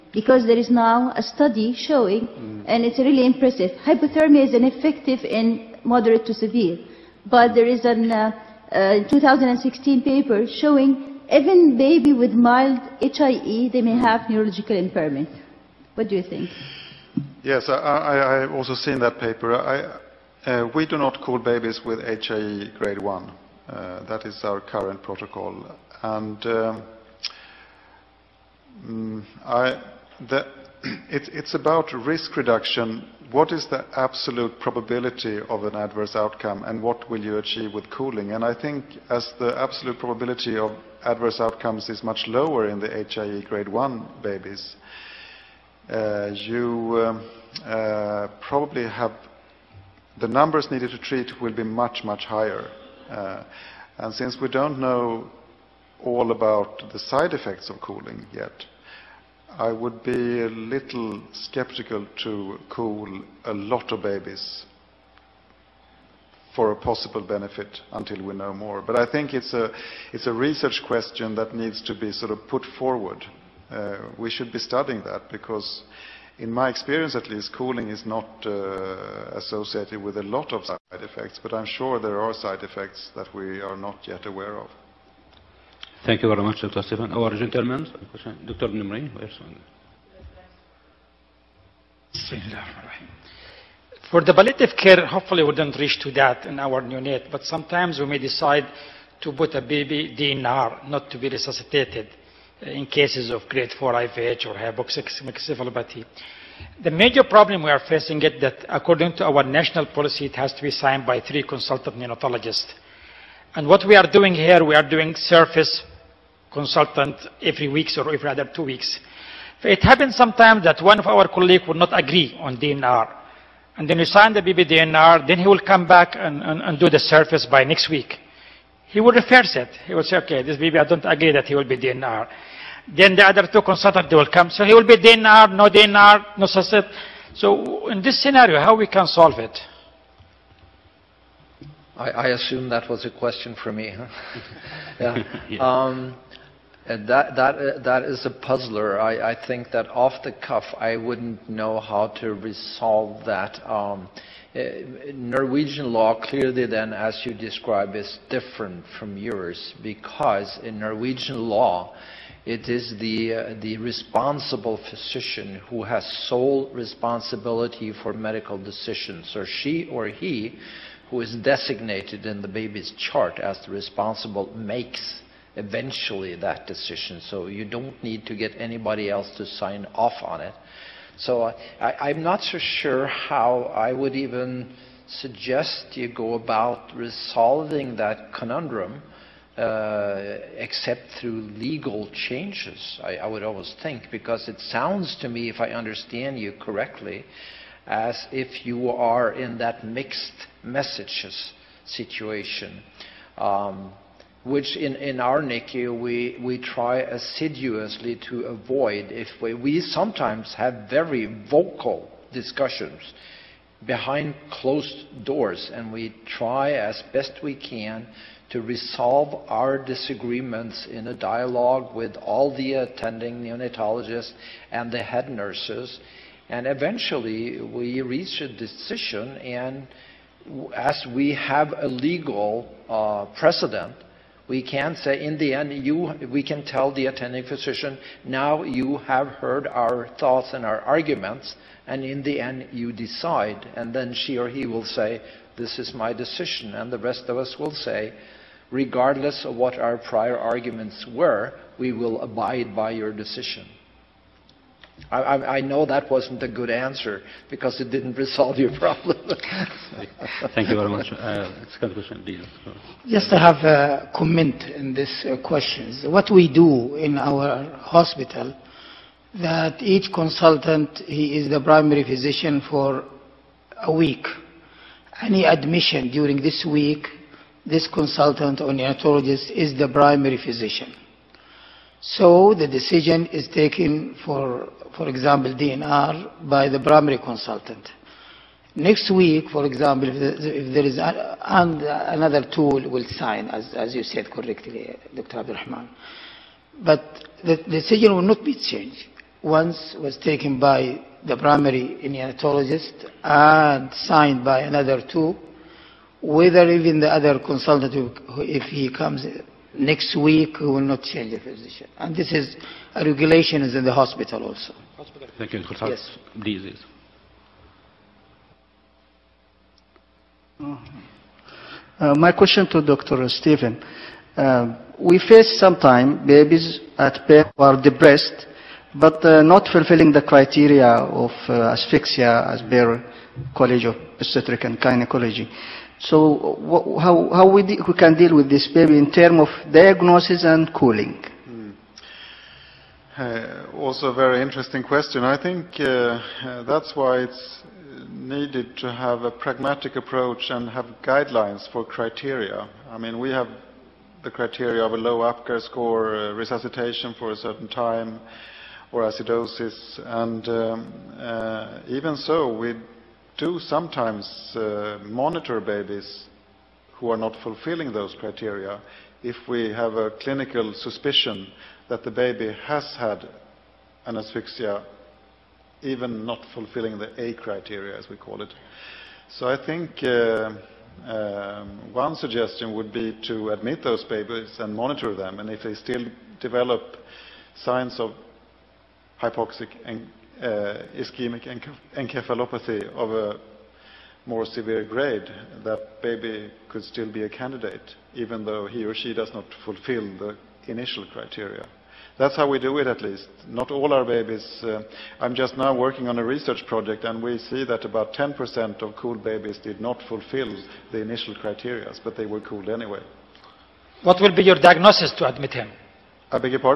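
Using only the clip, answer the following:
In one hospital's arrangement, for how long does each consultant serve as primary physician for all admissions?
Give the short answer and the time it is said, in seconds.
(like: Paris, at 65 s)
a week, at 273 s.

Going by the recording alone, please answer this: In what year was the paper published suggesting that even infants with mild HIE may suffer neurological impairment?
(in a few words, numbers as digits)
2016.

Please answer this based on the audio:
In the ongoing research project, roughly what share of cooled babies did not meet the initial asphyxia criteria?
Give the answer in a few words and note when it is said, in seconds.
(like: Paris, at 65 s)
10%, at 408 s.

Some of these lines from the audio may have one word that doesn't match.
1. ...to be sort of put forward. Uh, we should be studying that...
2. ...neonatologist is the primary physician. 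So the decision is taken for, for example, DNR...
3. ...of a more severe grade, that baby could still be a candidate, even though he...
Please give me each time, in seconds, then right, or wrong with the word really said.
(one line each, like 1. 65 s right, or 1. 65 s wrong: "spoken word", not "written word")
1. 71 s right
2. 278 s right
3. 392 s right.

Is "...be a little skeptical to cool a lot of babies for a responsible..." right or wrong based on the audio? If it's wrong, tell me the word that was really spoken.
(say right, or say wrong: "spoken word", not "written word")
wrong: "possible", not "responsible".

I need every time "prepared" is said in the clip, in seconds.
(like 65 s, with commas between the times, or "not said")
not said.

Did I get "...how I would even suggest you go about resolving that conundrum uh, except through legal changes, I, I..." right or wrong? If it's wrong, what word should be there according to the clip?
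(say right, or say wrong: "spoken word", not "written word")
right.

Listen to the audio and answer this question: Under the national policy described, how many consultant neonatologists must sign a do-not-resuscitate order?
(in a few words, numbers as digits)
3.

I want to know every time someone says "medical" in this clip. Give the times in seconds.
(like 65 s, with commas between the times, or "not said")
168 s.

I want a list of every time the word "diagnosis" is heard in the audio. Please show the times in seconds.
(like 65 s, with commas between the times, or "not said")
339 s, 414 s.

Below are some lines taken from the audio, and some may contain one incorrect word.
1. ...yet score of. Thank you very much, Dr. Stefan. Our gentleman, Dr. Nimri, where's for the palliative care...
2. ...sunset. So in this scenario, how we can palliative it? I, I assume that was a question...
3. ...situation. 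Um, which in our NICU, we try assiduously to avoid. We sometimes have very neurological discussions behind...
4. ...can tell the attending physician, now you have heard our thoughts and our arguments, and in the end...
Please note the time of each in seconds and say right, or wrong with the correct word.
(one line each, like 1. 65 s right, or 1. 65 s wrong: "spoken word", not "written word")
1. 84 s wrong: "aware", not "score"
2. 136 s wrong: "solve", not "palliative"
3. 201 s wrong: "vocal", not "neurological"
4. 236 s right.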